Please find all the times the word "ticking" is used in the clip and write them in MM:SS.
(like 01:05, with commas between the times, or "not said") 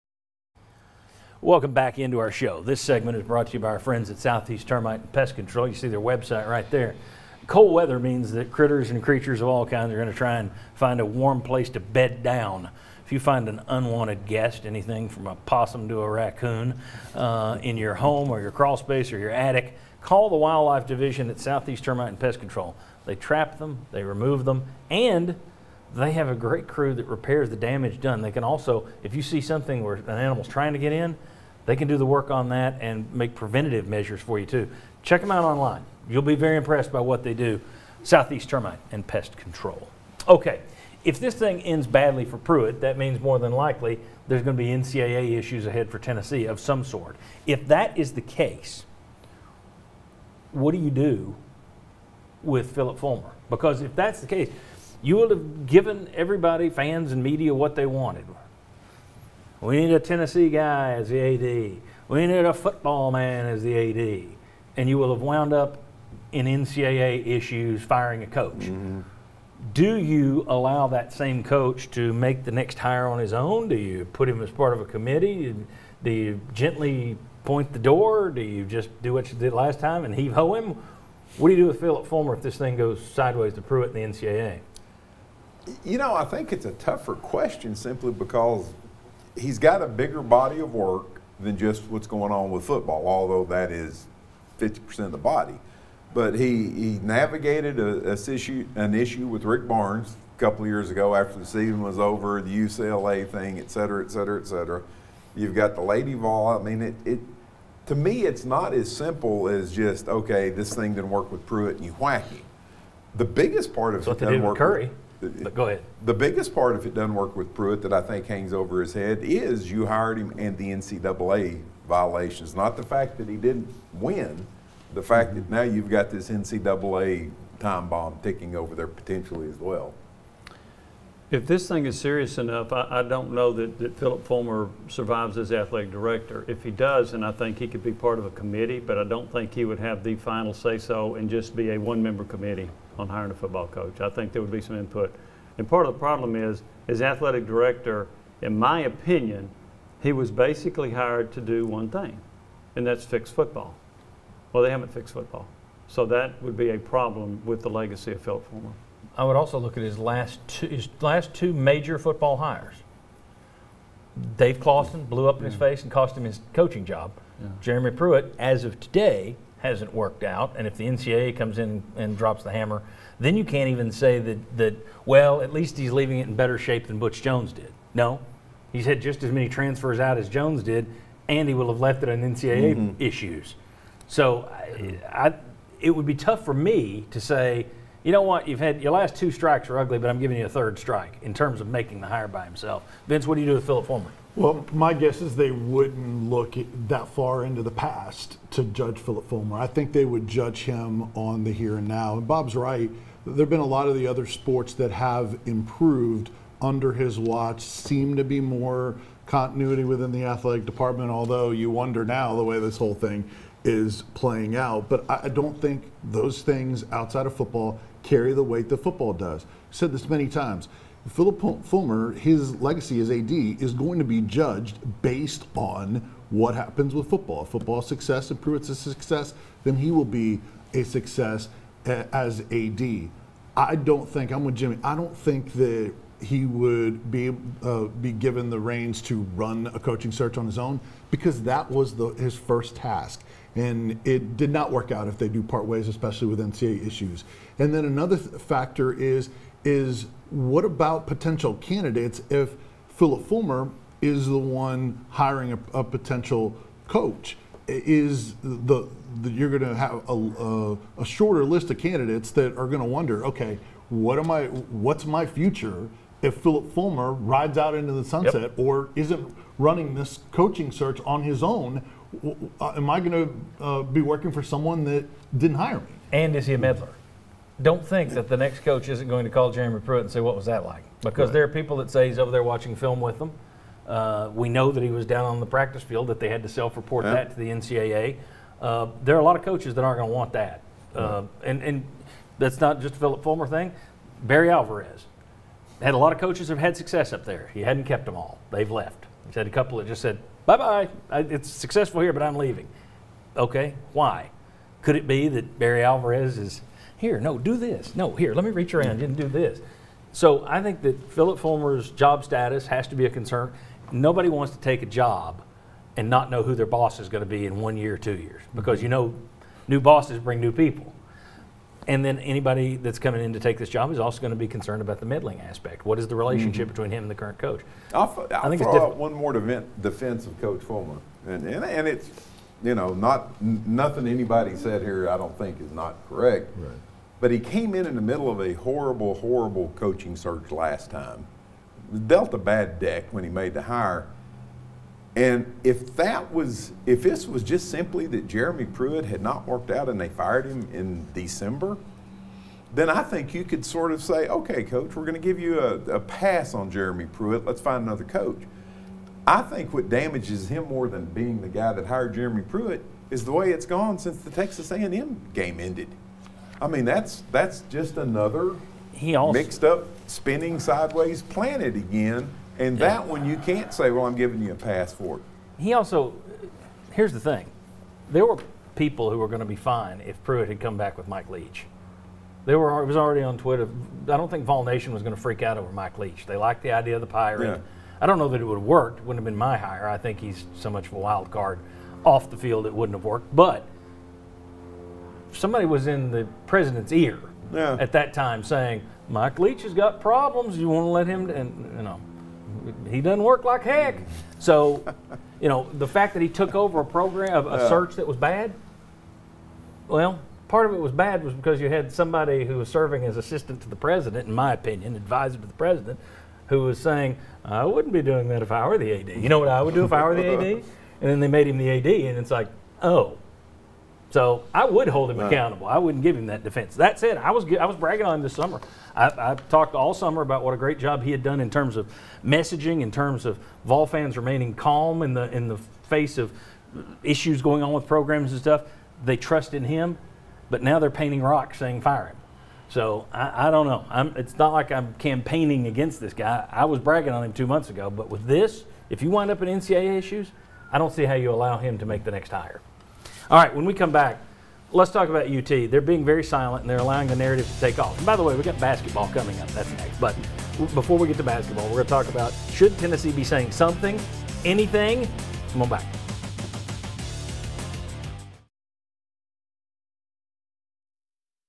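02:08.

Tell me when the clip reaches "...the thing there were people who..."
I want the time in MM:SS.
06:17.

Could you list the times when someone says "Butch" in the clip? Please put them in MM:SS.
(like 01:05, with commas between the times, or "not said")
02:56.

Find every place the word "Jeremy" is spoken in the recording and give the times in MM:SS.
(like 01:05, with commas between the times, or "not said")
02:47, 04:39, 05:48, 05:56, 06:02.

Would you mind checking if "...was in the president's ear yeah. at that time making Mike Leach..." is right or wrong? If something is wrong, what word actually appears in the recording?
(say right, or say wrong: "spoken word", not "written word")
wrong: "saying", not "making".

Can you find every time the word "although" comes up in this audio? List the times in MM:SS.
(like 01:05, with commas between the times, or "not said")
01:33, 03:31.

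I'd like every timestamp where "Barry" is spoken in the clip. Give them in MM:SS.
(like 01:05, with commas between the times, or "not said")
04:54, 05:05.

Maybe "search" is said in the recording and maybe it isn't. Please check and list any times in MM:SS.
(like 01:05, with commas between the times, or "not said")
04:00, 04:30, 05:40, 06:47.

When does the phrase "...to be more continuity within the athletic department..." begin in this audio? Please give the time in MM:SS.
03:28.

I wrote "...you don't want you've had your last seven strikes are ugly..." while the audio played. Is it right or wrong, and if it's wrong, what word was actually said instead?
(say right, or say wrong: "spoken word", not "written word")
wrong: "two", not "seven".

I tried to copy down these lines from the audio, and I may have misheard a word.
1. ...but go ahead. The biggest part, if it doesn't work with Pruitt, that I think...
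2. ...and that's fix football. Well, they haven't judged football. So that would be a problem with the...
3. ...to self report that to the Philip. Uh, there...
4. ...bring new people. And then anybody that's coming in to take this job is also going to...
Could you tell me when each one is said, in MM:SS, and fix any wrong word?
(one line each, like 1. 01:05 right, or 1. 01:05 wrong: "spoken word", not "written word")
1. 01:55 right
2. 02:32 wrong: "fixed", not "judged"
3. 04:46 wrong: "NCAA", not "Philip"
4. 05:20 right.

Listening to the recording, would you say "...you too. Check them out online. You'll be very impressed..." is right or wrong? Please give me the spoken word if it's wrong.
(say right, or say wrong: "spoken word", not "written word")
right.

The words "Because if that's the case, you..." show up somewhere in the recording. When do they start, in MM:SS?
00:53.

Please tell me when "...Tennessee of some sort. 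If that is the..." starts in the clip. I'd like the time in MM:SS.
00:45.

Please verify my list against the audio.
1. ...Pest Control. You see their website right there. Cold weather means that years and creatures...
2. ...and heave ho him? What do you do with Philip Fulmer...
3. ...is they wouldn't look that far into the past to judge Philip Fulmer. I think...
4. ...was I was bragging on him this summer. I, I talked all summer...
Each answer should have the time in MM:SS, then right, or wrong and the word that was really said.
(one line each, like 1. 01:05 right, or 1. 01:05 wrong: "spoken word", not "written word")
1. 00:05 wrong: "critters", not "years"
2. 01:20 right
3. 03:15 right
4. 07:07 right.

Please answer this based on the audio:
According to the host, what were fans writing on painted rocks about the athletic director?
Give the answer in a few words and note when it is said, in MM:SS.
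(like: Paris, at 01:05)
fire him, at 07:21.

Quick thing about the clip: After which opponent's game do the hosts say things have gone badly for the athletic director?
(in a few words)
Texas A&M.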